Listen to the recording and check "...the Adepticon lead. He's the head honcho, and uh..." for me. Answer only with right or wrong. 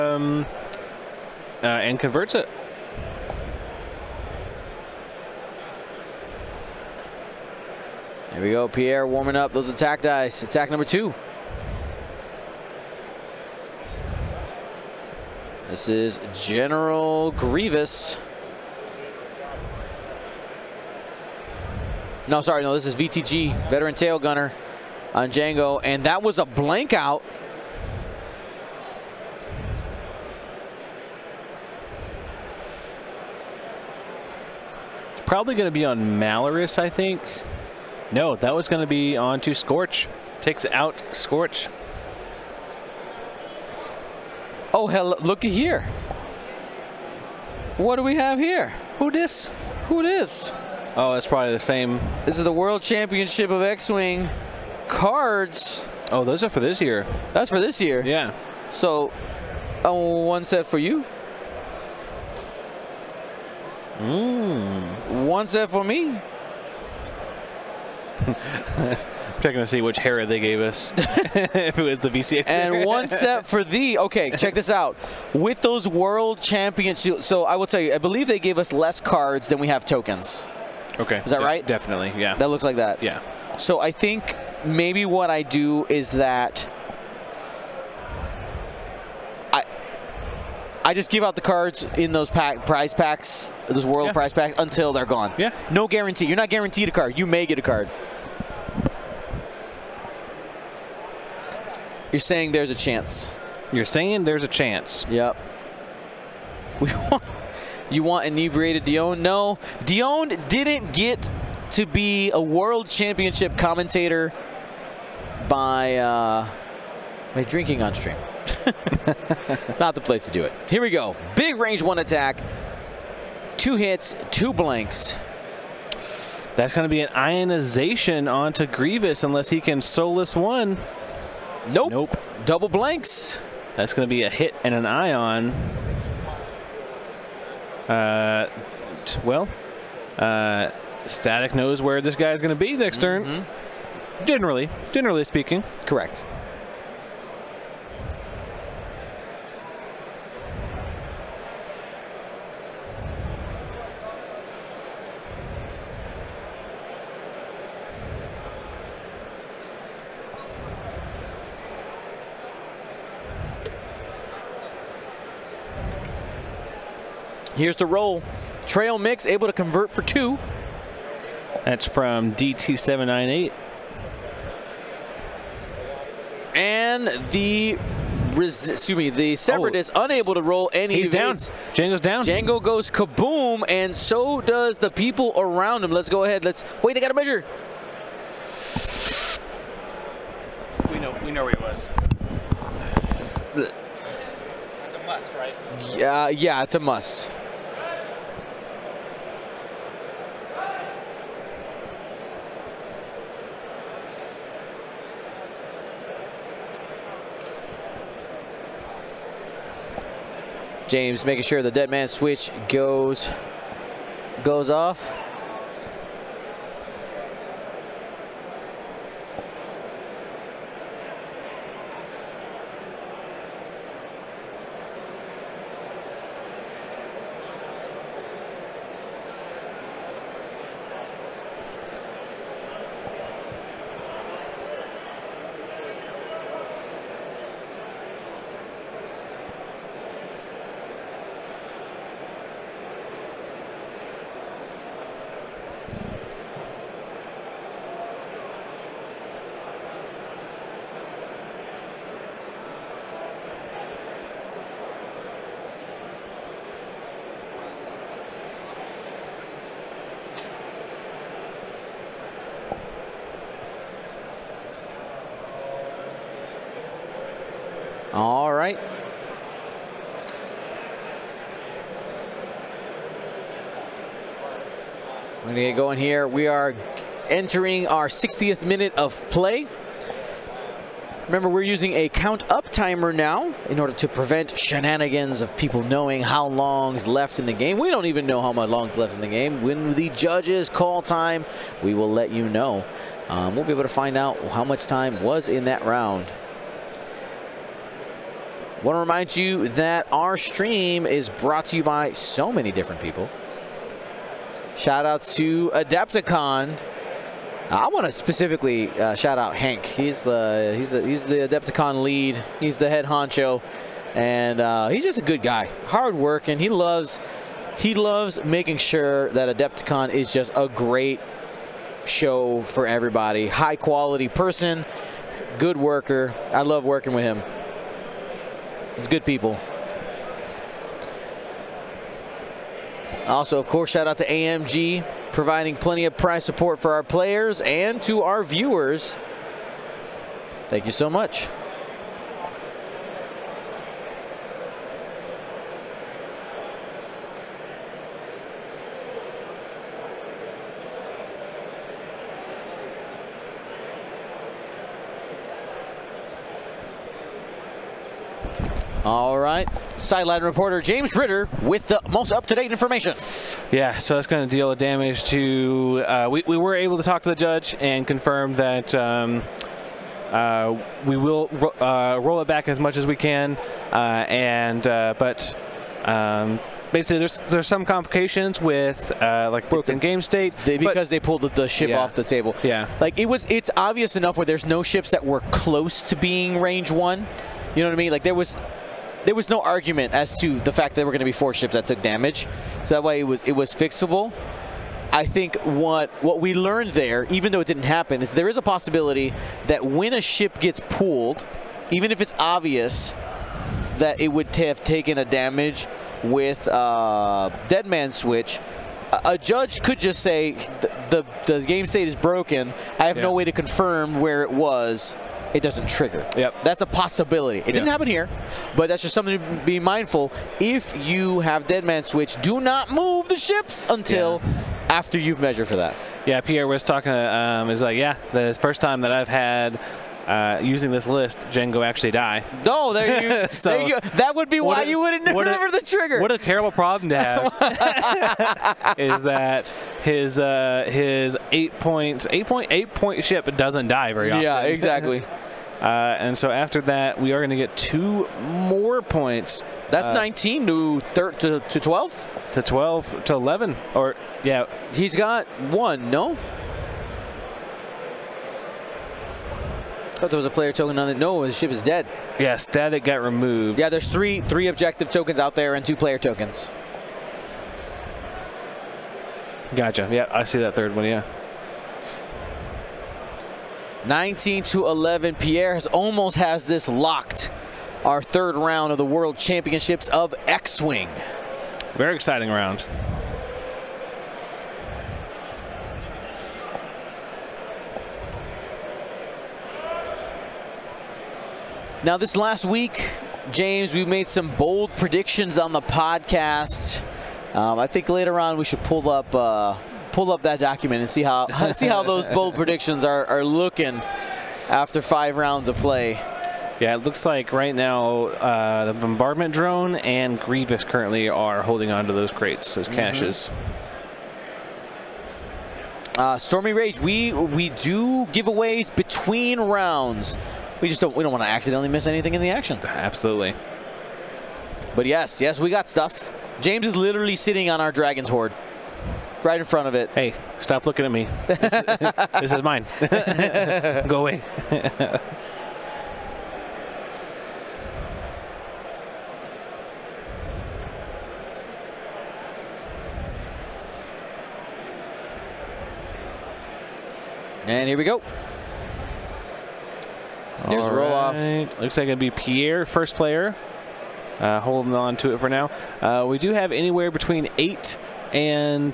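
right.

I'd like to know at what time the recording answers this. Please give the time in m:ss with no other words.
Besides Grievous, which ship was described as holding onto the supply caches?
8:28.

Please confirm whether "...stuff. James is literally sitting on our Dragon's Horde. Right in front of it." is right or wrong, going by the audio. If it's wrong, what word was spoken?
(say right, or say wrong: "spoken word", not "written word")
right.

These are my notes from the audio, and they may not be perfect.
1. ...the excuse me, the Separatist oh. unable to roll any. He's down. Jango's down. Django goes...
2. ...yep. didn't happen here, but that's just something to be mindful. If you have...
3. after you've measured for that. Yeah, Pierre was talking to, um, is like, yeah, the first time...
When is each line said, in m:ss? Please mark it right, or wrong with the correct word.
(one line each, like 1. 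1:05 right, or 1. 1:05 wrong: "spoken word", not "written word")
1. 2:57 right
2. 6:57 right
3. 7:04 right.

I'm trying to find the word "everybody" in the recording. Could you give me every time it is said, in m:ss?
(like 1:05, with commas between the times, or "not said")
5:22.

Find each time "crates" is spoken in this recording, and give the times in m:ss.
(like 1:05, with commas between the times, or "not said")
8:32.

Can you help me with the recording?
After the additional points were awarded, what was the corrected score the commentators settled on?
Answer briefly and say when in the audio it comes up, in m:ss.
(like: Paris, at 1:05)
19 to 11, at 7:54.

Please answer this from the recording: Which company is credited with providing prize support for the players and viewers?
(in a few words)
AMG.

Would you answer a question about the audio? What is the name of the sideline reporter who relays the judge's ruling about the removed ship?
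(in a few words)
James Ritter.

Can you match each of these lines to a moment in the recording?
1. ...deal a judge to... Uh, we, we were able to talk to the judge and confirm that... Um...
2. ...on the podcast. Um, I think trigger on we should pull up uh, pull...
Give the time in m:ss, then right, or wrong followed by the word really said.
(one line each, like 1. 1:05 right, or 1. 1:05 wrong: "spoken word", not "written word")
1. 6:04 wrong: "damage", not "judge"
2. 8:15 wrong: "later", not "trigger".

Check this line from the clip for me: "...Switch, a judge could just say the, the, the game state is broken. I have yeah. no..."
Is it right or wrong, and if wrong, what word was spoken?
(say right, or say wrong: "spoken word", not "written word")
right.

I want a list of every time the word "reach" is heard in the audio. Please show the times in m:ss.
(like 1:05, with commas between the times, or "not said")
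not said.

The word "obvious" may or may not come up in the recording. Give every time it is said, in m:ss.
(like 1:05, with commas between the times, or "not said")
6:23, 6:42.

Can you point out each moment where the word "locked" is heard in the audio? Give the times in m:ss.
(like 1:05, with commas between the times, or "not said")
7:56.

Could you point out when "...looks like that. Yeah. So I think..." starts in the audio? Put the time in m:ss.
1:22.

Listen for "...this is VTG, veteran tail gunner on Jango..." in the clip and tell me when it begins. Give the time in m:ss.
0:22.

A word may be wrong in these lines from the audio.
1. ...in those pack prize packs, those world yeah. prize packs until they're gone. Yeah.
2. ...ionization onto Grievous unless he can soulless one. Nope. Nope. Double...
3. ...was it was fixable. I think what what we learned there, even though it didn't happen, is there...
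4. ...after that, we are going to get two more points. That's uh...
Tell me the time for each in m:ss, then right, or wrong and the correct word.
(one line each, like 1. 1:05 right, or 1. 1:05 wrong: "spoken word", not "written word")
1. 1:31 right
2. 2:07 right
3. 6:33 right
4. 7:26 right.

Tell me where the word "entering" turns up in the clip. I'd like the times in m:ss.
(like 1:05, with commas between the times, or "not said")
4:37.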